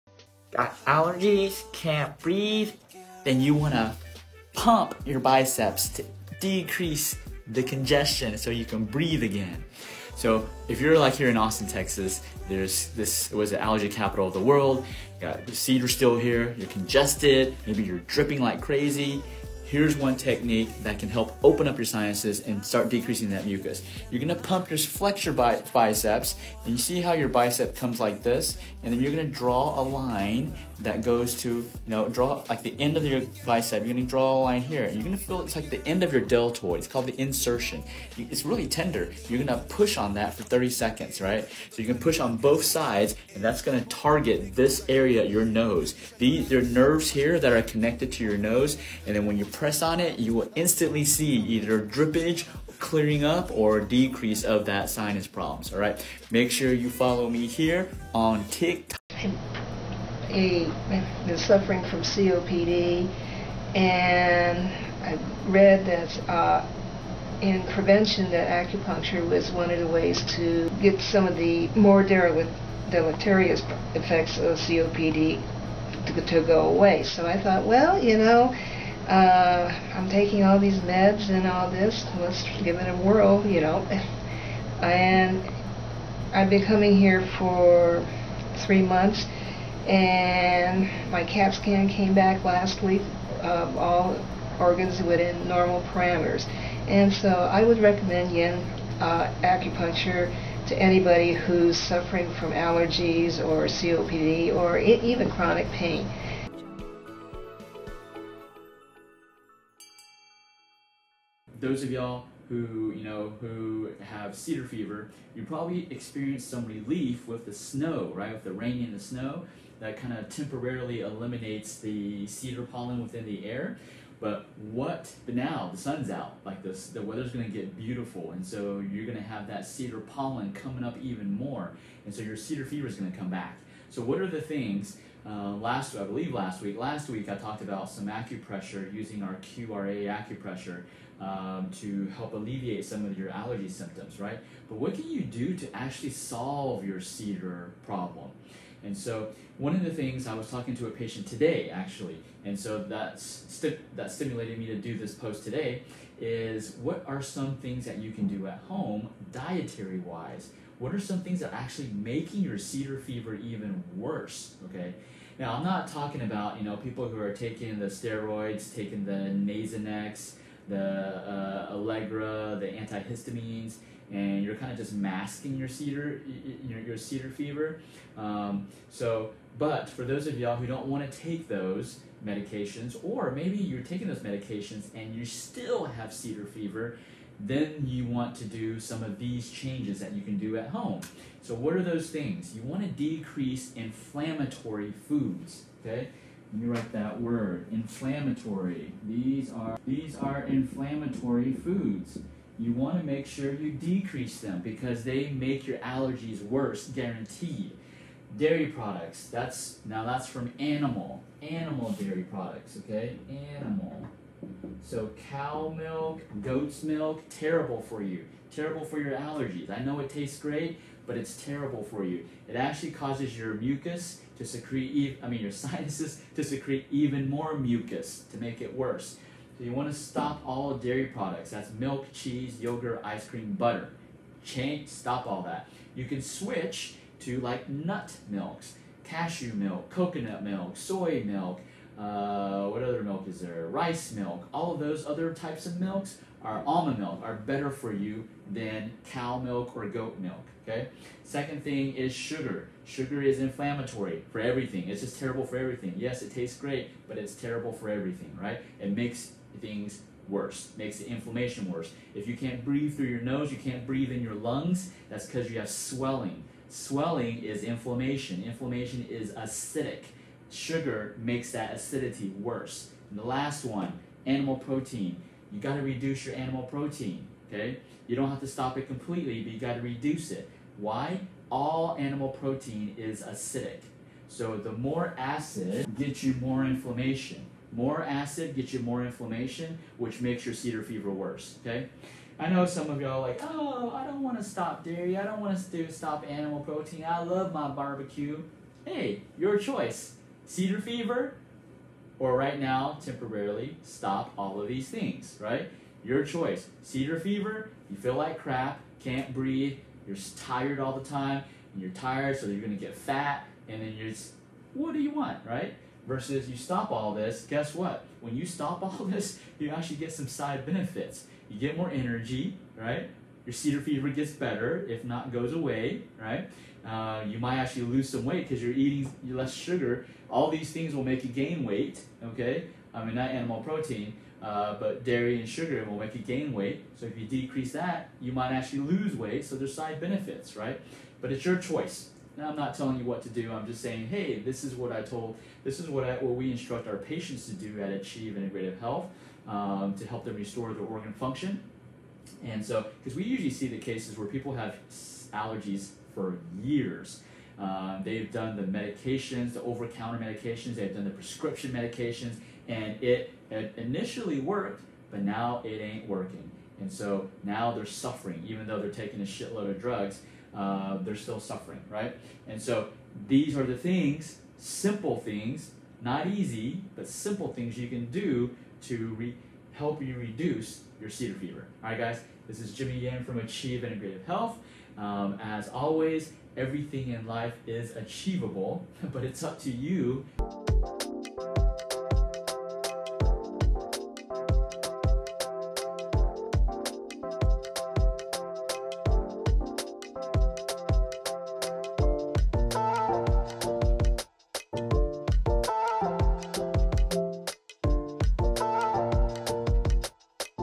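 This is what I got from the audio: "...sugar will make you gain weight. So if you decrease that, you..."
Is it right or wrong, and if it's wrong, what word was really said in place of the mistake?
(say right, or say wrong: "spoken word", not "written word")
right.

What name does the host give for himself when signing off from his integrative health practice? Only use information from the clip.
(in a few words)
Jimmy Yan.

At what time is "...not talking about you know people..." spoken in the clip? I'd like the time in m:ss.
2:45.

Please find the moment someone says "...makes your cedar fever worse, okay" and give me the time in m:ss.
4:50.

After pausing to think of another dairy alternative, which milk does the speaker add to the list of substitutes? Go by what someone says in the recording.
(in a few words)
Rice milk.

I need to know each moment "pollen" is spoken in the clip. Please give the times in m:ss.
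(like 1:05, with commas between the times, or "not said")
2:02, 2:10.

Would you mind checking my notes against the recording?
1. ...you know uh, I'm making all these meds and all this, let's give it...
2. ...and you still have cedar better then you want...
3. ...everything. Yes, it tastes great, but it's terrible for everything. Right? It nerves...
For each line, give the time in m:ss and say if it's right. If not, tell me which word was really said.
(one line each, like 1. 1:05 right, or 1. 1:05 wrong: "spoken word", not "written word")
1. 1:18 wrong: "taking", not "making"
2. 3:04 wrong: "fever", not "better"
3. 4:15 wrong: "makes", not "nerves".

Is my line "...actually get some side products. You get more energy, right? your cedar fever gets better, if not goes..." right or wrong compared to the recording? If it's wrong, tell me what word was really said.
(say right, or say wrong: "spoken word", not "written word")
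wrong: "benefits", not "products".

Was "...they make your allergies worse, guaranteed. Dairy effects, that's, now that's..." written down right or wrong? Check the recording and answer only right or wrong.
wrong.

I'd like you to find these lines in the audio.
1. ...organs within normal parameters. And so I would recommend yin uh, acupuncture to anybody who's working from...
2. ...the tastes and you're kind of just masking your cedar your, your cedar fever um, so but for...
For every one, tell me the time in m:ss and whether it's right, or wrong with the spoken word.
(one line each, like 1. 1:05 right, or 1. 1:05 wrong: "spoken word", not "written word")
1. 1:34 wrong: "suffering", not "working"
2. 2:52 wrong: "antihistamines", not "tastes".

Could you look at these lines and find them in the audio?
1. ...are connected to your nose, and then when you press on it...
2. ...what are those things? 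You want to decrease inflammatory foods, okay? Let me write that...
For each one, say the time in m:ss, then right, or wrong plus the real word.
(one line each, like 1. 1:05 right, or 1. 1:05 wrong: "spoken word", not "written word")
1. 0:47 right
2. 3:11 right.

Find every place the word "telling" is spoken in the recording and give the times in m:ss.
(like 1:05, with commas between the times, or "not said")
5:42.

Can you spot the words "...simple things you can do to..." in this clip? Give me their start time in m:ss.
6:17.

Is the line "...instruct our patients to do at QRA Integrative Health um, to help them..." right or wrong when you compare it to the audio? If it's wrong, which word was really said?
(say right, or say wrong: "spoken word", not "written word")
wrong: "Achieve", not "QRA".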